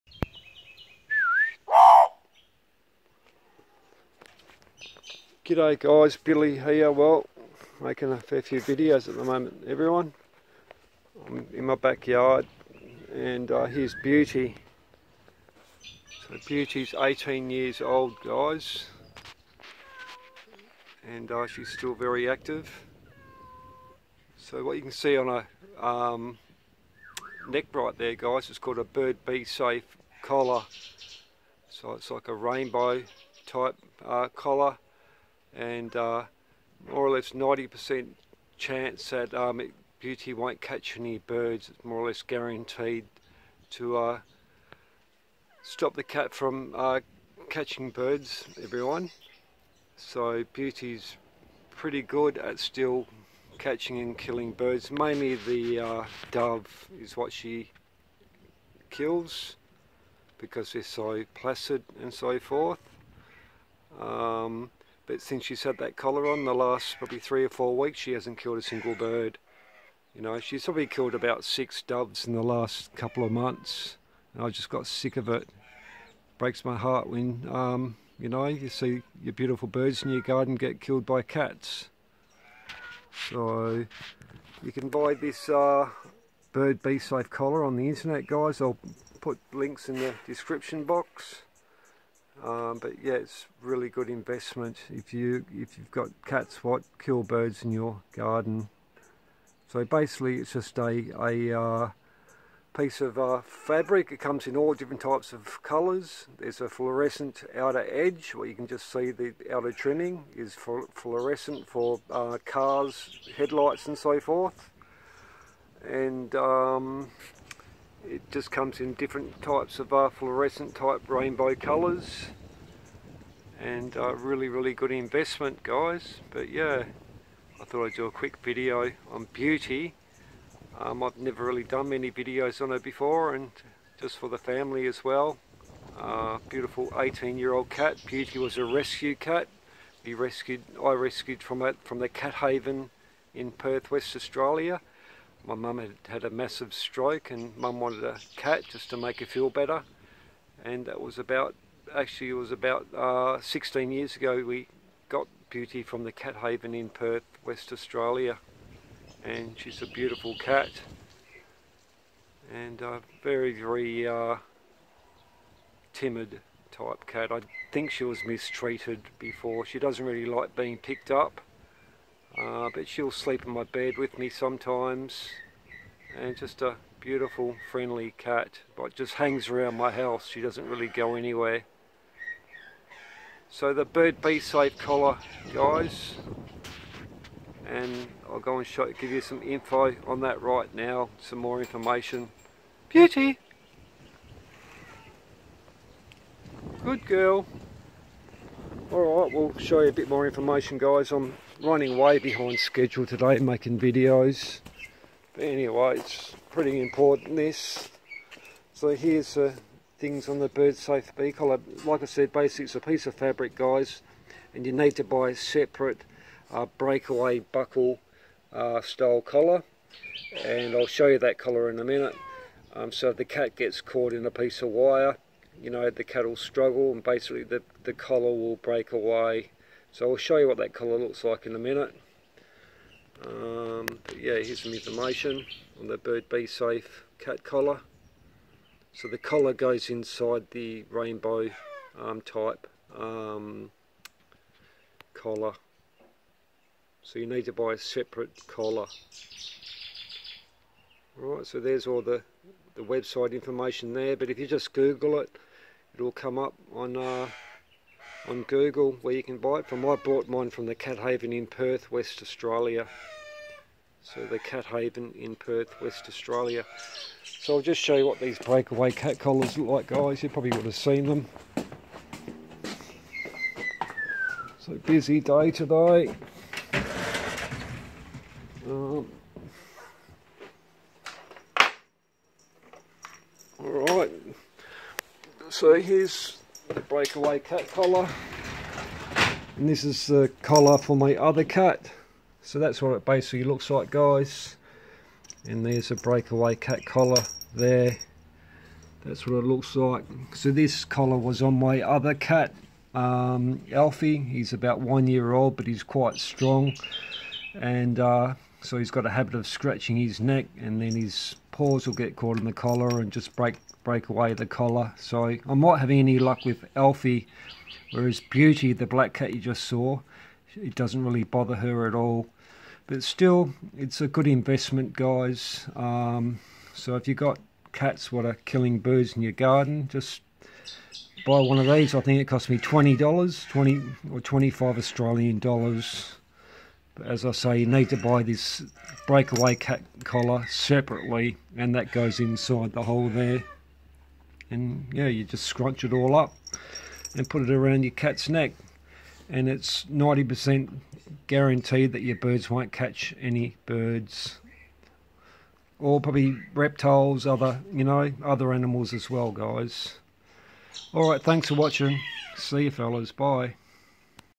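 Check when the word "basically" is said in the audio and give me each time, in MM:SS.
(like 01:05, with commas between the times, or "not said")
01:39, 03:32, 03:47, 04:53.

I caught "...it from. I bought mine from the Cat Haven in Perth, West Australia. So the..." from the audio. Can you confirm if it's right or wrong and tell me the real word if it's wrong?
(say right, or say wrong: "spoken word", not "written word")
right.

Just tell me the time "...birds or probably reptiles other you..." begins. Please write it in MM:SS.
05:53.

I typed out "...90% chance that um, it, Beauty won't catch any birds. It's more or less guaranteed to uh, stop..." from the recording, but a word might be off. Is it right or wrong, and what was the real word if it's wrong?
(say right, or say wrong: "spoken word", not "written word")
right.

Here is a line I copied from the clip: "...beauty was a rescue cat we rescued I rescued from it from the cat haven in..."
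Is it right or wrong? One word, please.
right.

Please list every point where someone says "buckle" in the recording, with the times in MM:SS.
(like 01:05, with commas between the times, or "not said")
03:37.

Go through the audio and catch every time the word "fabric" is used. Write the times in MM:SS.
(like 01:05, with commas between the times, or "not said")
01:43, 03:33.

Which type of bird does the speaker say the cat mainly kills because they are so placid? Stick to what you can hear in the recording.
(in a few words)
Dove.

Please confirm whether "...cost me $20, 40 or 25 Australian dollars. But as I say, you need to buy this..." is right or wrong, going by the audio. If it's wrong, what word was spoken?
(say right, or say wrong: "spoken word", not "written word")
wrong: "20", not "40".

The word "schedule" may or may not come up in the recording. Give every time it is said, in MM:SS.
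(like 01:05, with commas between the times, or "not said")
03:22.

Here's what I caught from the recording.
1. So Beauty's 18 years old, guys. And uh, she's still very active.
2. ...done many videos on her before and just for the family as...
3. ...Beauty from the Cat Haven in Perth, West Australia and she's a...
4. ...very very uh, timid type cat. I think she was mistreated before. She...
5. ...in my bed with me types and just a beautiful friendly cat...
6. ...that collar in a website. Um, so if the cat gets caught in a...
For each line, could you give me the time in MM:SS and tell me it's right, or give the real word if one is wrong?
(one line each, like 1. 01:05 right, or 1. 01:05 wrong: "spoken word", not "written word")
1. 00:16 right
2. 02:11 right
3. 02:35 right
4. 02:43 right
5. 02:53 wrong: "sometimes", not "types"
6. 03:41 wrong: "minute", not "website".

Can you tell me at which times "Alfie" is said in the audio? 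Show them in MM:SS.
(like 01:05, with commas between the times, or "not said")
05:03, 05:16.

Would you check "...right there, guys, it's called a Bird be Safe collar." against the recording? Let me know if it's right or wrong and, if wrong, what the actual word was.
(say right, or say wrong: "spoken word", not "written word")
right.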